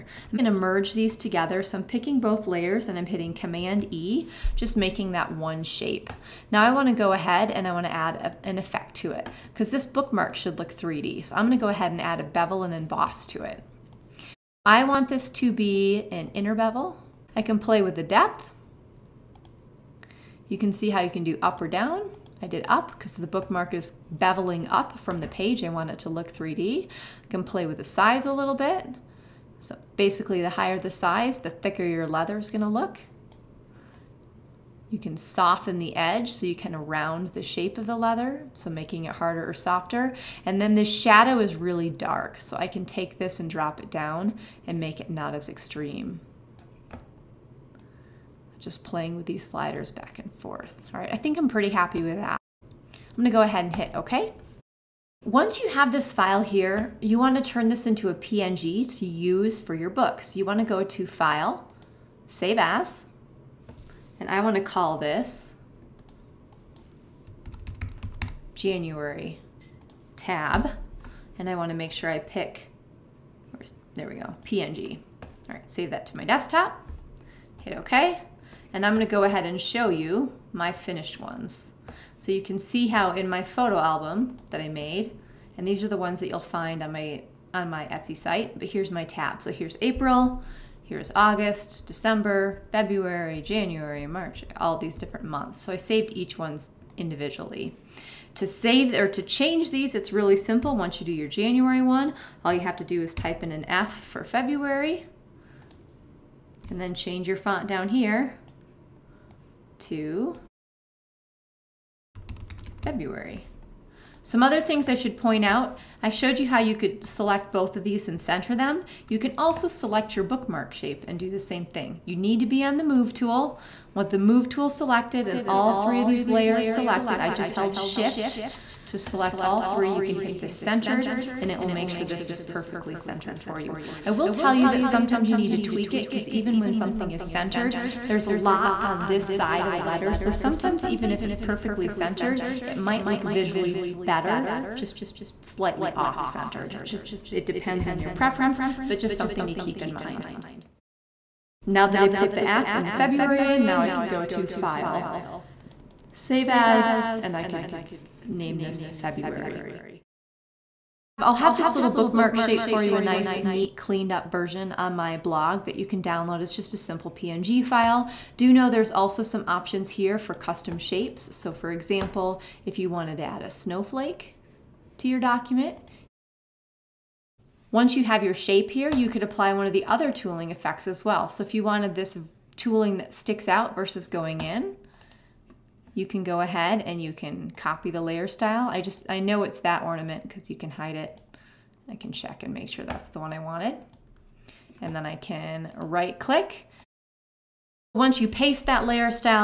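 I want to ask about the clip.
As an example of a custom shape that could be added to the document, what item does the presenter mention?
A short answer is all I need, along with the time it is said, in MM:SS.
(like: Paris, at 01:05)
a snowflake, at 02:53.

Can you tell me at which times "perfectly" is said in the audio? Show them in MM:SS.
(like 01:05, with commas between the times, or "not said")
02:12, 02:21.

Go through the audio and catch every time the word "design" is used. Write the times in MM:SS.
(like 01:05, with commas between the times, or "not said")
not said.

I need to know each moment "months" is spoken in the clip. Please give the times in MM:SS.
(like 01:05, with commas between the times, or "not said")
01:35.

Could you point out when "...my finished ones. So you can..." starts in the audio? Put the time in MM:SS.
01:20.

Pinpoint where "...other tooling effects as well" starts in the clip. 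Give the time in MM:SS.
02:59.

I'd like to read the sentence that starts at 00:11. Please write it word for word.
So I'm gonna go ahead and add a bevel and emboss to it.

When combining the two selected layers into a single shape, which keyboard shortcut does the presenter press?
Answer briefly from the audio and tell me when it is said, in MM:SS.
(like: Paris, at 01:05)
Command E, at 00:03.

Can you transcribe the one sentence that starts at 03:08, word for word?
I just, I know it's that ornament because you can hide it.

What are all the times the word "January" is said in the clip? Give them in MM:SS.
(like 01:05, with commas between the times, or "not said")
01:08, 01:33, 01:41.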